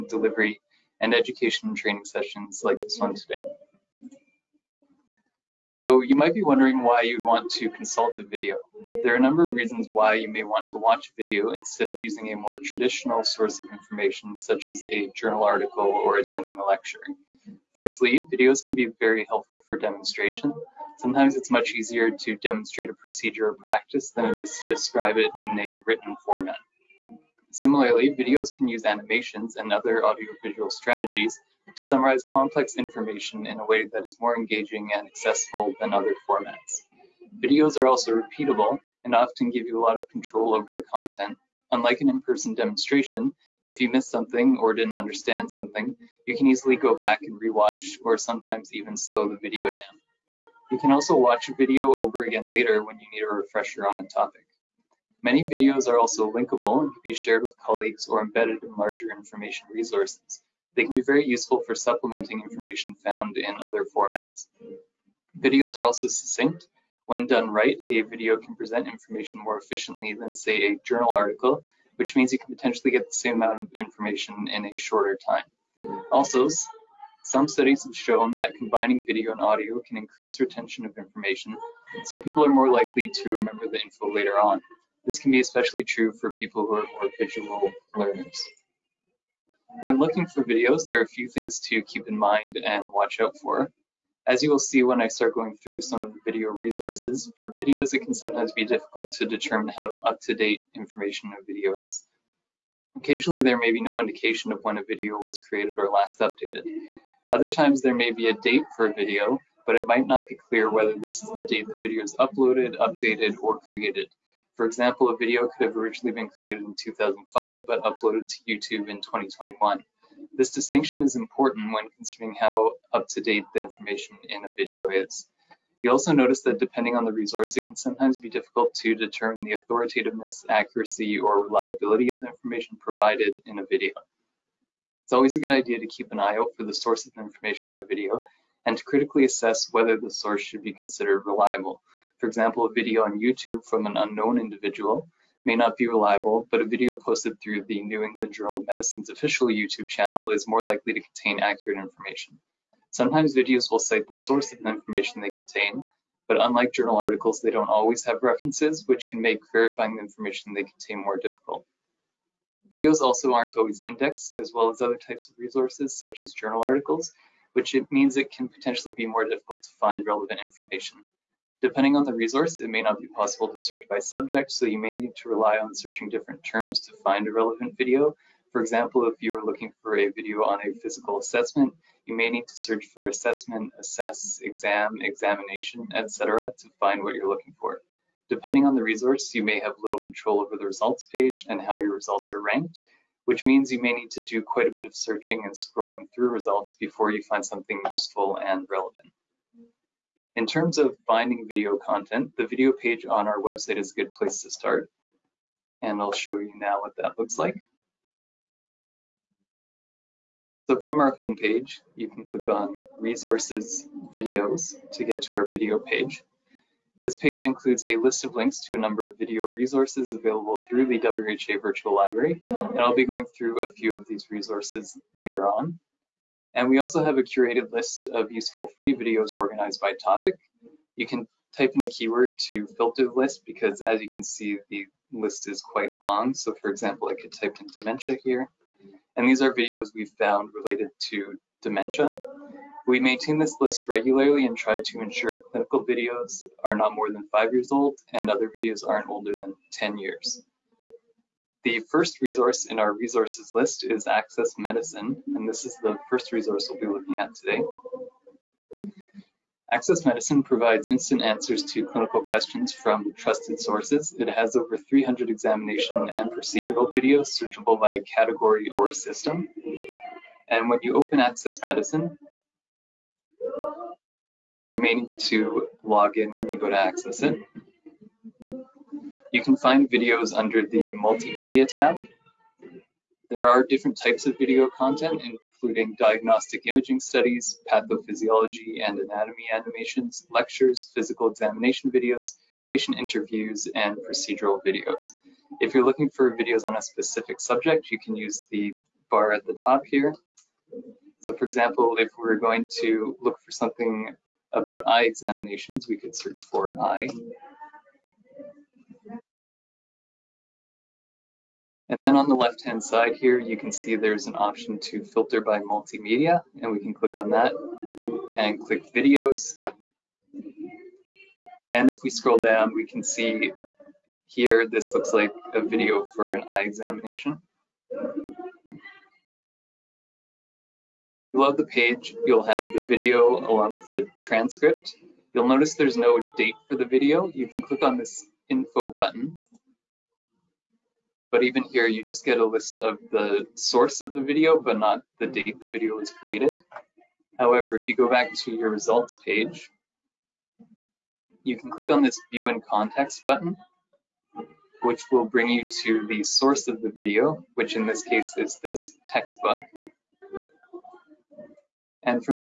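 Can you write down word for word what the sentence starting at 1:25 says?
This can be especially true for people who are more visual learners.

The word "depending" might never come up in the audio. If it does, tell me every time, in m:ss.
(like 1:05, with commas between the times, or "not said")
2:06, 2:51, 3:08.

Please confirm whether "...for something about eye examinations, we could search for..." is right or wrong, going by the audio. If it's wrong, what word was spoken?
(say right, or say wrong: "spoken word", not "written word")
right.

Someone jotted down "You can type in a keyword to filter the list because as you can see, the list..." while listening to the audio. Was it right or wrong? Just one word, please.
right.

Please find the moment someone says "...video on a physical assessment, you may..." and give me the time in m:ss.
3:00.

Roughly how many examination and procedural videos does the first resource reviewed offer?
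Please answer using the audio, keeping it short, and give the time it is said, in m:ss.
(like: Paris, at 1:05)
300, at 4:24.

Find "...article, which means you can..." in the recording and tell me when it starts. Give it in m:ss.
1:11.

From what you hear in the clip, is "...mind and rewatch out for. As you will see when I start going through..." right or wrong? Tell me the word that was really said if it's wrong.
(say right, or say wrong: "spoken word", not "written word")
wrong: "watch", not "rewatch".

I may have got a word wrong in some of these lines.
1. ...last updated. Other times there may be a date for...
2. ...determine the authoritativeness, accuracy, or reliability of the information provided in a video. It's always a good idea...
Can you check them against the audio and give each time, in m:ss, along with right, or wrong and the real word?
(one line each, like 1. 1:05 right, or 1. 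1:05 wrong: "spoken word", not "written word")
1. 1:45 right
2. 2:08 right.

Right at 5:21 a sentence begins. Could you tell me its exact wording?
And if we scroll down, we can see here, this looks like a video for an eye examination.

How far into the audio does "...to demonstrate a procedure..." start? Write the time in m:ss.
0:22.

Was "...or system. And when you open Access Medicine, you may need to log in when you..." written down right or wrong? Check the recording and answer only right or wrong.
right.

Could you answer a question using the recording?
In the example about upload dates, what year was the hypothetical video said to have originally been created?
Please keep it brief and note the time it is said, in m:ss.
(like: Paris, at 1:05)
2005, at 1:56.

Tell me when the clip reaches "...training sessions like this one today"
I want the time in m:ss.
0:01.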